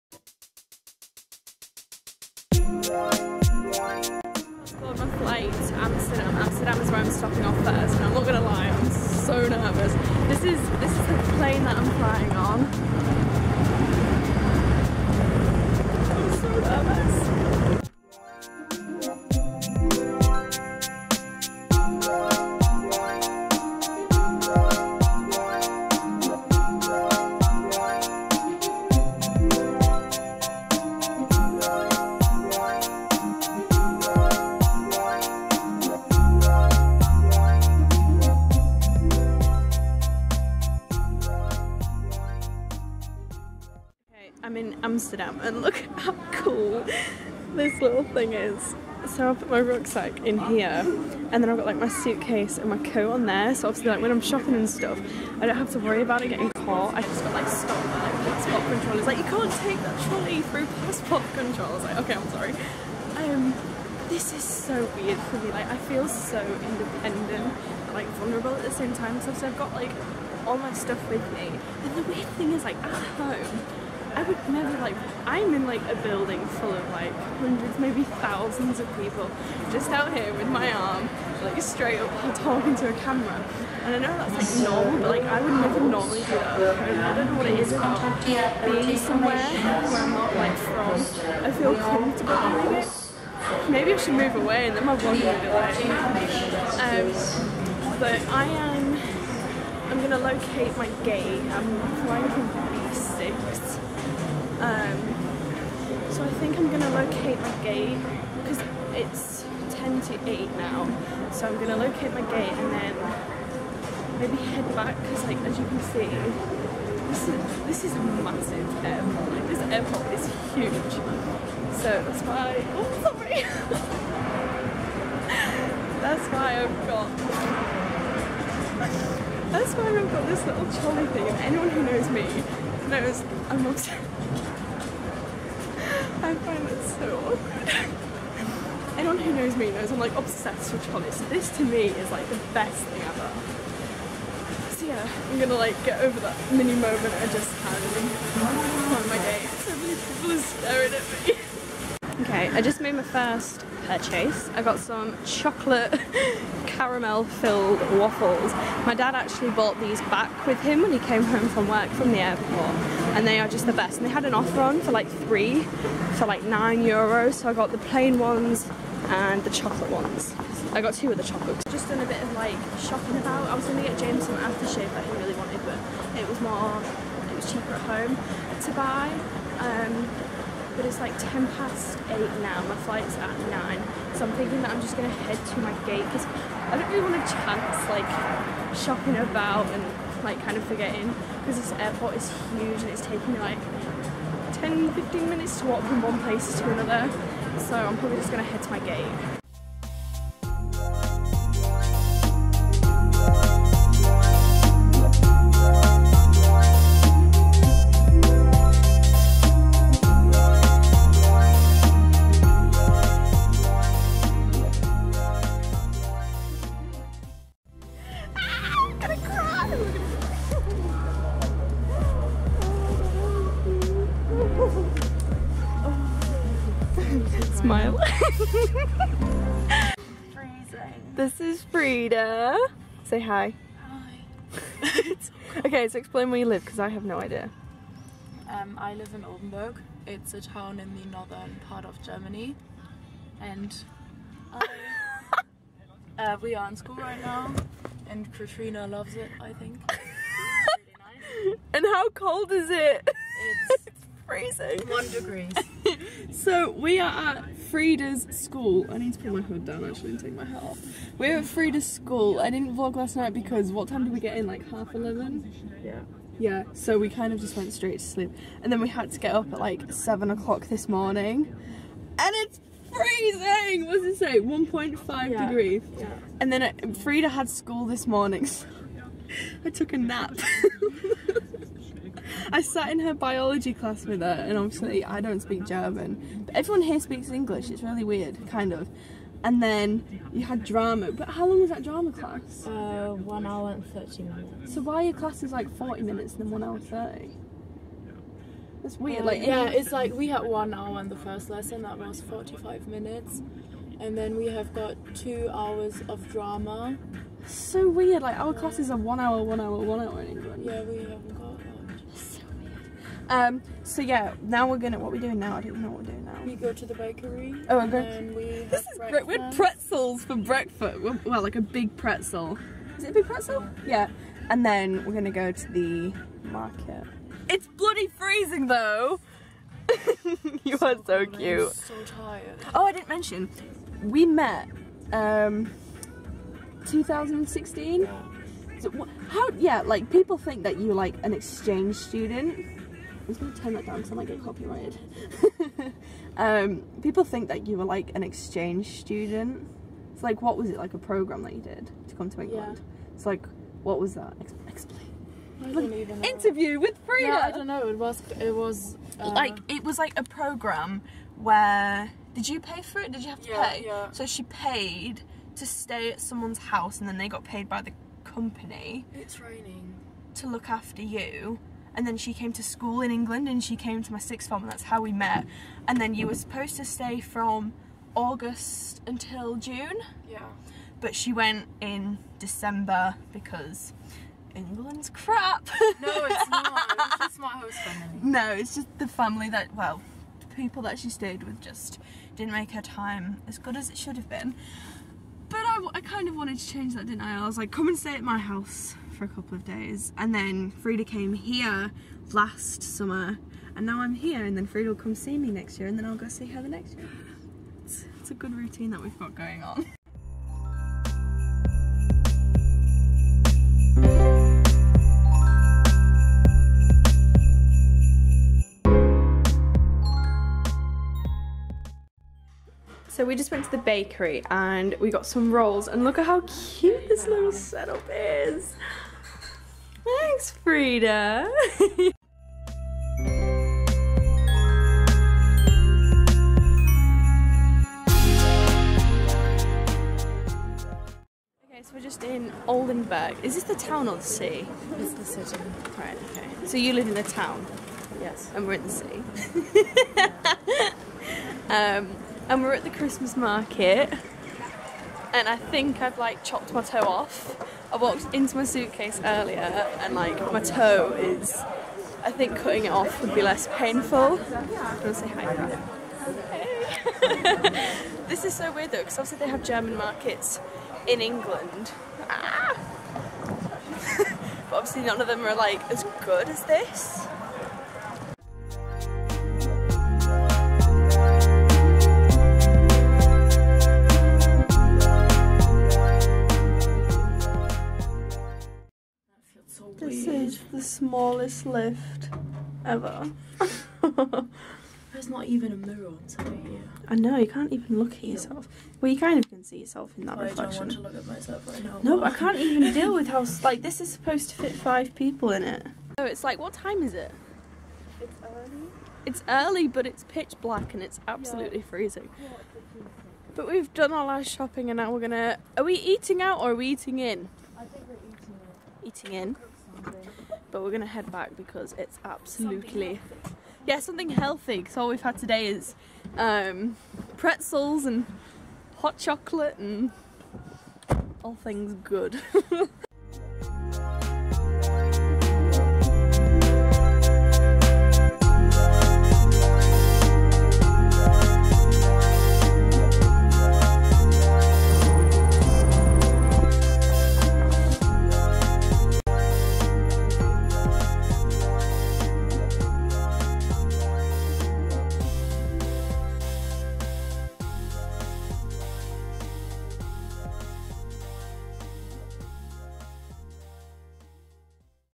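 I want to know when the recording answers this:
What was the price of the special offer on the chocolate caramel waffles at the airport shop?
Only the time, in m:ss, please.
2:46.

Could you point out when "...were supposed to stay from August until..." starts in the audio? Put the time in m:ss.
6:16.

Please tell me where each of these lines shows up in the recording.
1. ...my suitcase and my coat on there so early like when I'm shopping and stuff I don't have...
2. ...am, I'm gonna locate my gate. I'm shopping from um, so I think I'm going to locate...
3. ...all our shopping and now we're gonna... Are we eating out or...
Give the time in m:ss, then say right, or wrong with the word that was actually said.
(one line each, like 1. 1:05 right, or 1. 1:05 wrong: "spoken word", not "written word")
1. 0:51 wrong: "obviously", not "early"
2. 1:38 wrong: "flying", not "shopping"
3. 8:34 right.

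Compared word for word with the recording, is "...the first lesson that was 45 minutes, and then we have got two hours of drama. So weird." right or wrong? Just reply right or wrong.
right.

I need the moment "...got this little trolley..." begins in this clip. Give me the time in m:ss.
2:10.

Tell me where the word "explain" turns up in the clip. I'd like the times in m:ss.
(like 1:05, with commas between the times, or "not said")
3:55, 5:55.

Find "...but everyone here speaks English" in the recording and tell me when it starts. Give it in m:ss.
4:46.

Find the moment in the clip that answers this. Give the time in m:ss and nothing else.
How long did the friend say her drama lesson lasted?
4:53.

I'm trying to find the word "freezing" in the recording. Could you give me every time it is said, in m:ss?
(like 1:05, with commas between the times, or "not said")
4:14, 4:32, 5:28, 8:31.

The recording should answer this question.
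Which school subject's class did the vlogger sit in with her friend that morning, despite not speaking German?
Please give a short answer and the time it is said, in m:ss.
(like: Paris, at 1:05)
Biology, at 4:43.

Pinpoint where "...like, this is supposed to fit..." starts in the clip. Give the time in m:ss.
8:23.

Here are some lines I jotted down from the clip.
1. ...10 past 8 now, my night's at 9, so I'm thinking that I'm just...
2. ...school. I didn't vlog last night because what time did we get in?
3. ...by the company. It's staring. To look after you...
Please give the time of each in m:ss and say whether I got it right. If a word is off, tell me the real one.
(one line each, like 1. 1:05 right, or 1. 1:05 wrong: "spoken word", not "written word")
1. 3:01 wrong: "flight", not "night"
2. 4:21 right
3. 6:07 wrong: "raining", not "staring".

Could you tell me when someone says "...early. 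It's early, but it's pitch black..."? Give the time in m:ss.
8:28.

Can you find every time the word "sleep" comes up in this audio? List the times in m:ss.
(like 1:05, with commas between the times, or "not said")
4:28.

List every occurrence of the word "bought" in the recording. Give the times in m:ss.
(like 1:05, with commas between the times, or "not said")
2:39.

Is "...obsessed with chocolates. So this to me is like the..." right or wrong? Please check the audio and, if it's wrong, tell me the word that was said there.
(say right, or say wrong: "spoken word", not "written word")
right.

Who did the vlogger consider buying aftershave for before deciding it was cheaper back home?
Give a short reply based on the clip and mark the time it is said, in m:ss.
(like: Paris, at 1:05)
James, at 2:53.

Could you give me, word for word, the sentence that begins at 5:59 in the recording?
like it was like a program where did you pay for it?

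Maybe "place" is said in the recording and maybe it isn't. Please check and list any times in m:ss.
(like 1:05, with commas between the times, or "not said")
3:16.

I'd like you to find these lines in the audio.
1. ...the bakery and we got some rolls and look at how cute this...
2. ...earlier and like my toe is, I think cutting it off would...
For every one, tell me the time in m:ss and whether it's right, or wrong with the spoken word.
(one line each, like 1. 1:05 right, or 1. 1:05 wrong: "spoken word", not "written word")
1. 7:03 right
2. 7:39 right.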